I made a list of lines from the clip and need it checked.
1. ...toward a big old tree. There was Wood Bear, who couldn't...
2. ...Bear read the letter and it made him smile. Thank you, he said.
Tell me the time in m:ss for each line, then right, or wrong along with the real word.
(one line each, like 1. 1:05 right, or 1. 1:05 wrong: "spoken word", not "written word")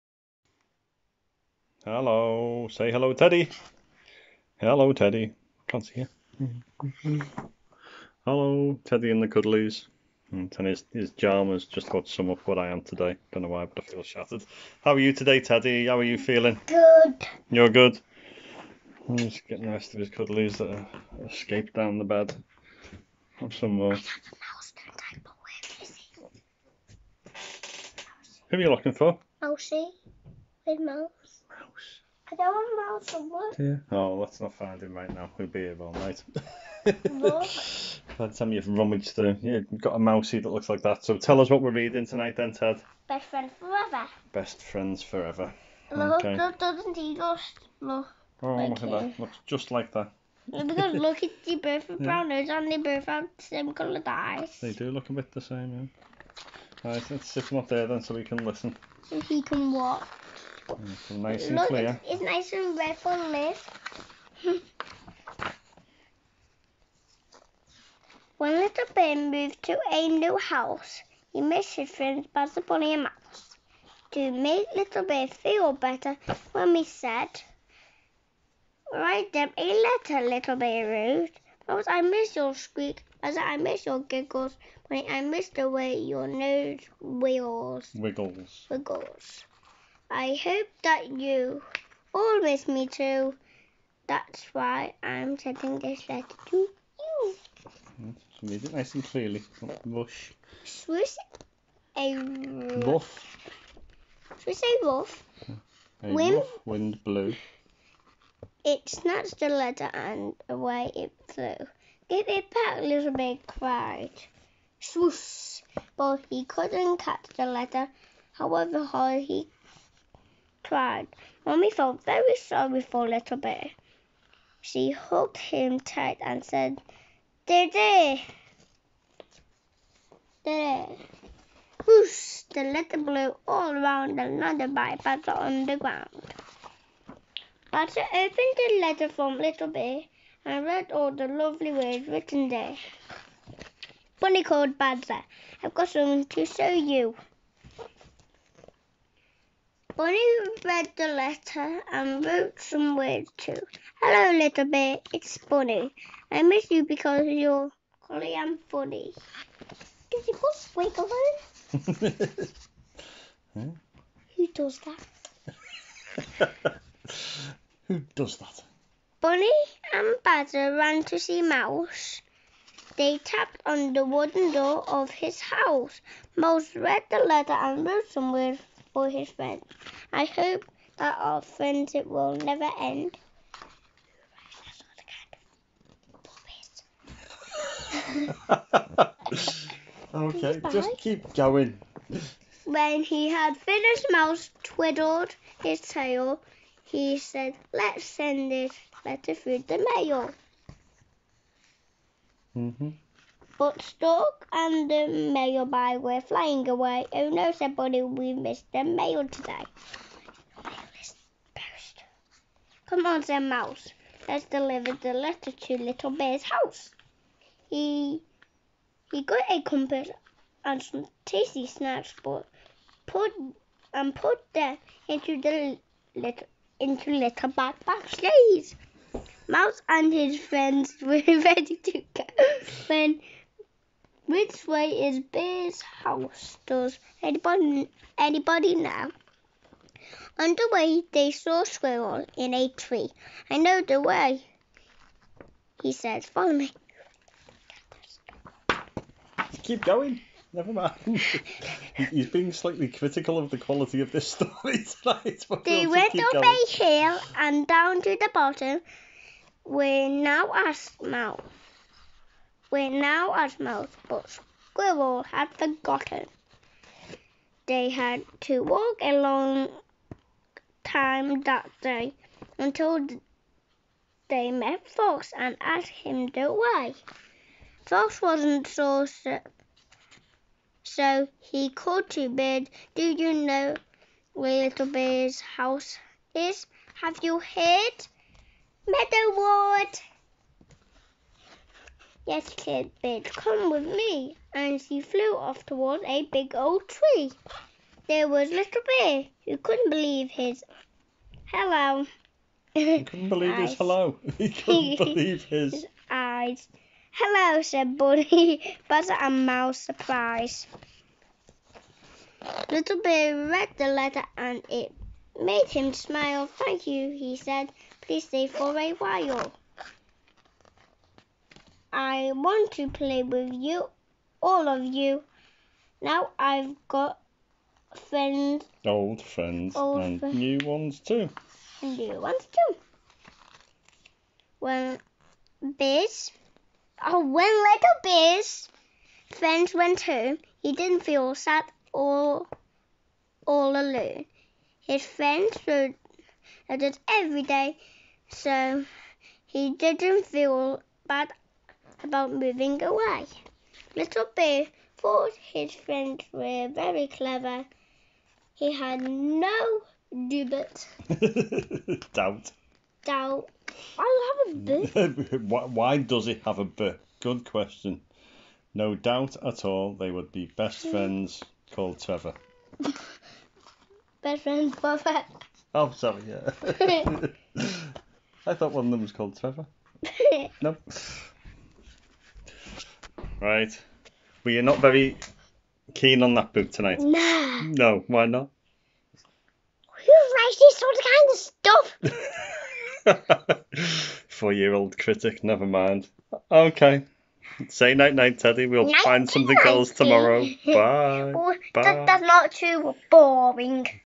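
1. 4:55 wrong: "Little", not "Wood"
2. 5:13 right.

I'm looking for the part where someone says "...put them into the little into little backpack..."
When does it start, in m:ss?
3:44.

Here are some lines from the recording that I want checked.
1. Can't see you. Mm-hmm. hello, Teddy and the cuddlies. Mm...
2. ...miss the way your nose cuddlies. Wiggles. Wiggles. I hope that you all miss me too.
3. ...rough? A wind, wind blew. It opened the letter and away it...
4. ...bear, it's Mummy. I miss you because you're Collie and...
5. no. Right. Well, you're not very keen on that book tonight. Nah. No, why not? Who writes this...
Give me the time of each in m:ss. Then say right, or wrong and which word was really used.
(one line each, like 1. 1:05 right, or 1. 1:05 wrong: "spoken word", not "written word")
1. 0:05 right
2. 1:25 wrong: "wiggles", not "cuddlies"
3. 1:44 wrong: "snatched", not "opened"
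4. 2:34 wrong: "Bonnie", not "Mummy"
5. 6:20 right.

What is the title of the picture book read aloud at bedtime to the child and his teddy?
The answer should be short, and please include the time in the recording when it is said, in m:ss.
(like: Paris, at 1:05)
Best Friends Forever, at 0:44.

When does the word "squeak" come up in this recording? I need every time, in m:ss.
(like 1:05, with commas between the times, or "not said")
1:22, 2:40.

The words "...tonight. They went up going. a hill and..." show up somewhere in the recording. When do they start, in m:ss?
4:15.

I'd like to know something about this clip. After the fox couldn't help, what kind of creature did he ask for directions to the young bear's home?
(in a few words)
Bird.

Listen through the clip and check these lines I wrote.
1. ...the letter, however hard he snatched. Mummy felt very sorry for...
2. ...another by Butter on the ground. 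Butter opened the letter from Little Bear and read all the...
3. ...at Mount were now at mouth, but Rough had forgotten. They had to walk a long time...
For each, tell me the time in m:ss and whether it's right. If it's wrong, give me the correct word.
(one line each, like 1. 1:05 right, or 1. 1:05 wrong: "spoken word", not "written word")
1. 1:57 wrong: "cried", not "snatched"
2. 2:14 right
3. 4:20 wrong: "Squirrel", not "Rough".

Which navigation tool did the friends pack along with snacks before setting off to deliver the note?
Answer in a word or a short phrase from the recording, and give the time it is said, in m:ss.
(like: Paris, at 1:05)
A compass, at 3:39.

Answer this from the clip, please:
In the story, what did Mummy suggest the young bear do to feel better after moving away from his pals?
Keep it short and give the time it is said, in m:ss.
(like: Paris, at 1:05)
Write them a letter, at 1:18.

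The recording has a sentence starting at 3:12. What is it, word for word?
When he had finished, Mouse twiddled his tail.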